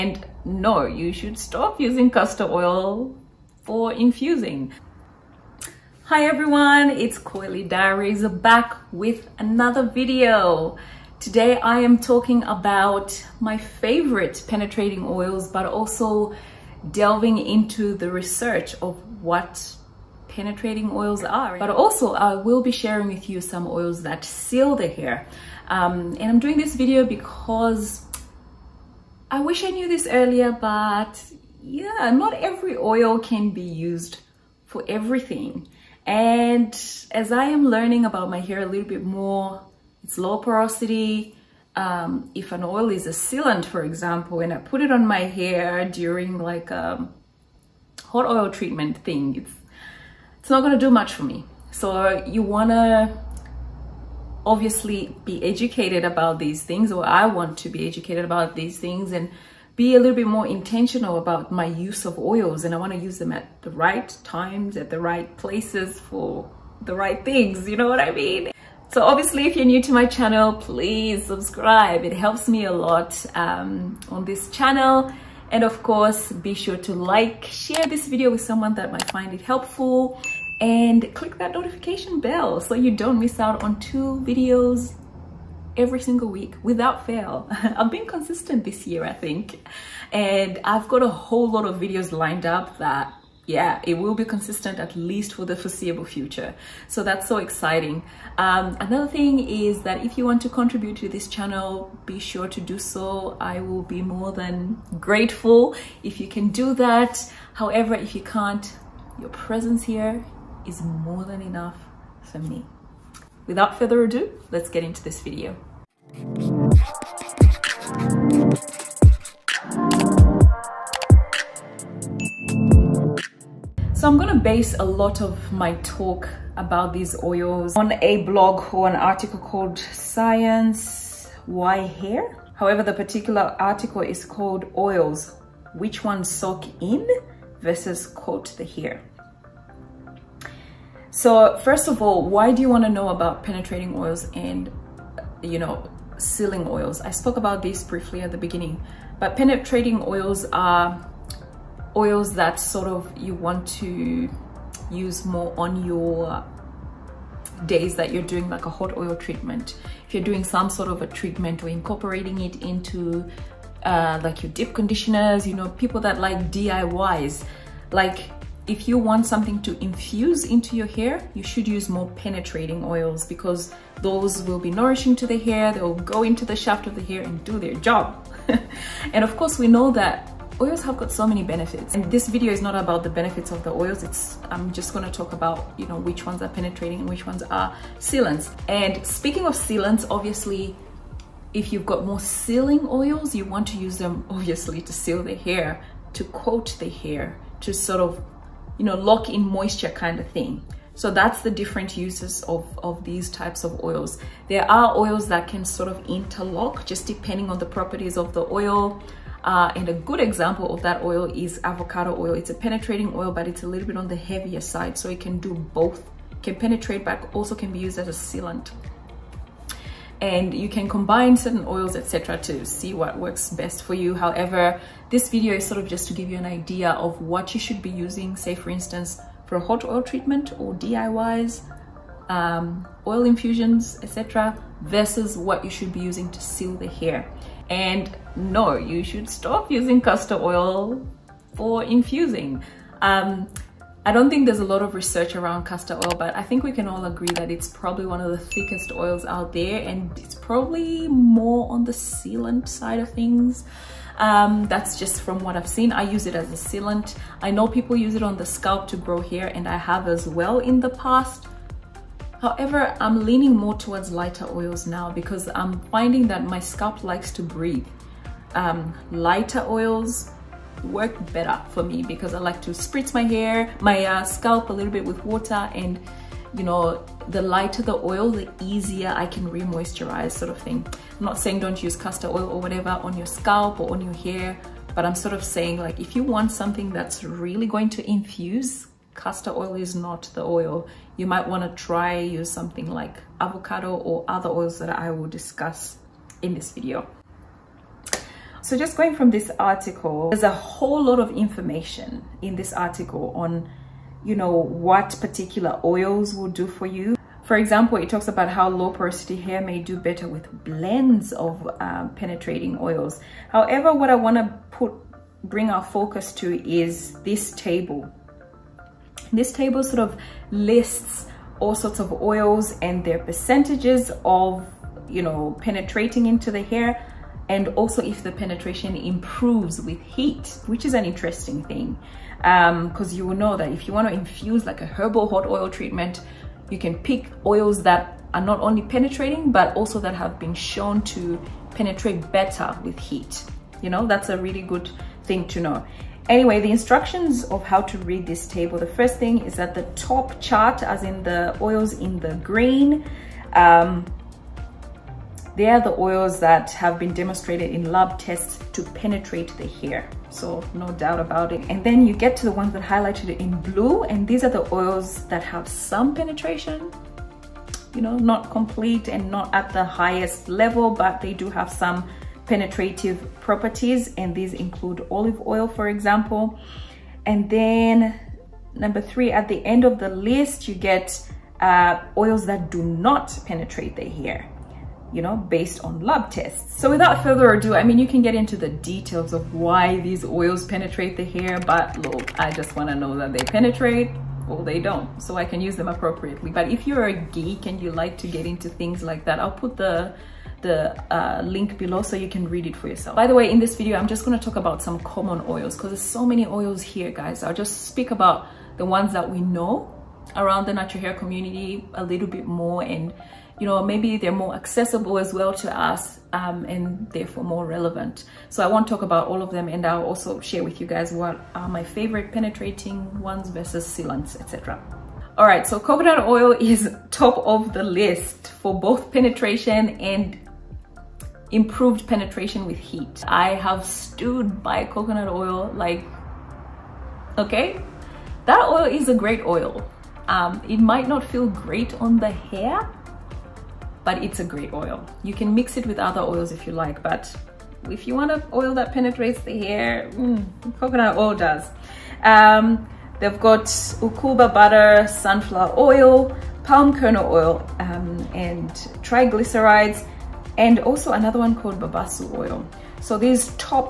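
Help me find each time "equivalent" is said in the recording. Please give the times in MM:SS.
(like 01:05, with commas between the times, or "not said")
not said.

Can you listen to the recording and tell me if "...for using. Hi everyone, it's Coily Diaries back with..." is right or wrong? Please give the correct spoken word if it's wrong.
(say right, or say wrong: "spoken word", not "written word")
wrong: "infusing", not "using".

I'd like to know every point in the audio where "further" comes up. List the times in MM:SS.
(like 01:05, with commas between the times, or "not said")
01:53, 06:27.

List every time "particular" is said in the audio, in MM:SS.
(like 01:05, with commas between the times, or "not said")
02:12, 05:05.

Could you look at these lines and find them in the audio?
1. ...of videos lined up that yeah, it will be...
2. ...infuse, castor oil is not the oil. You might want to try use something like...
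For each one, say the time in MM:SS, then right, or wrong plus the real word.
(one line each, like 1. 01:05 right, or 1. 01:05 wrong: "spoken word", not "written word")
1. 01:31 right
2. 04:48 right.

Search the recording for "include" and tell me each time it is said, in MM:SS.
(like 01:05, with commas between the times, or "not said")
06:14.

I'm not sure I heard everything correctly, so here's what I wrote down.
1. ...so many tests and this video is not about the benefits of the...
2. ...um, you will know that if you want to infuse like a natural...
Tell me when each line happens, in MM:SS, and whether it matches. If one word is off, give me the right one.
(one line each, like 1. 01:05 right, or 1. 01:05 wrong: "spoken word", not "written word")
1. 03:01 wrong: "benefits", not "tests"
2. 05:33 wrong: "herbal", not "natural".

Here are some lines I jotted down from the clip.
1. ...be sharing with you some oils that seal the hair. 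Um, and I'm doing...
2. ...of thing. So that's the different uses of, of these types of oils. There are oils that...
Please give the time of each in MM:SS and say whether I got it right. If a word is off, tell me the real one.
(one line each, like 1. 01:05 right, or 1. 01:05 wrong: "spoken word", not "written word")
1. 00:22 right
2. 03:20 right.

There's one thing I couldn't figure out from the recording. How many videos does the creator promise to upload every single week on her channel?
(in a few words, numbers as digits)
2.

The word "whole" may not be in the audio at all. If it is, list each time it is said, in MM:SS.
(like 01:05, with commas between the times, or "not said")
01:31, 05:00.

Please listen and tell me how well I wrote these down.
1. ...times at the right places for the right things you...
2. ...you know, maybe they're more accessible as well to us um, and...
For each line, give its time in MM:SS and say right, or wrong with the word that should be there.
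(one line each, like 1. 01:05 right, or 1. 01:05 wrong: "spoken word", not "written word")
1. 01:04 right
2. 06:53 right.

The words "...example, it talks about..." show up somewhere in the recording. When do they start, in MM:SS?
05:07.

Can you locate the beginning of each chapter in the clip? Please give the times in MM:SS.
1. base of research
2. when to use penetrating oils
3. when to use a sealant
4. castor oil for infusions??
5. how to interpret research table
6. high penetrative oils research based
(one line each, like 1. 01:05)
1. 01:59
2. 02:21
3. 03:07
4. 03:57
5. 04:59
6. 07:04.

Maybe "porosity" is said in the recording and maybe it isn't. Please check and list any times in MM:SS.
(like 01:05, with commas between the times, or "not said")
00:40, 05:08.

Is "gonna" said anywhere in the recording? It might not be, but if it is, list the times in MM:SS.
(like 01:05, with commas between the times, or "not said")
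00:50, 02:04, 06:44.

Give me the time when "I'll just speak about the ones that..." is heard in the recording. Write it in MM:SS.
06:47.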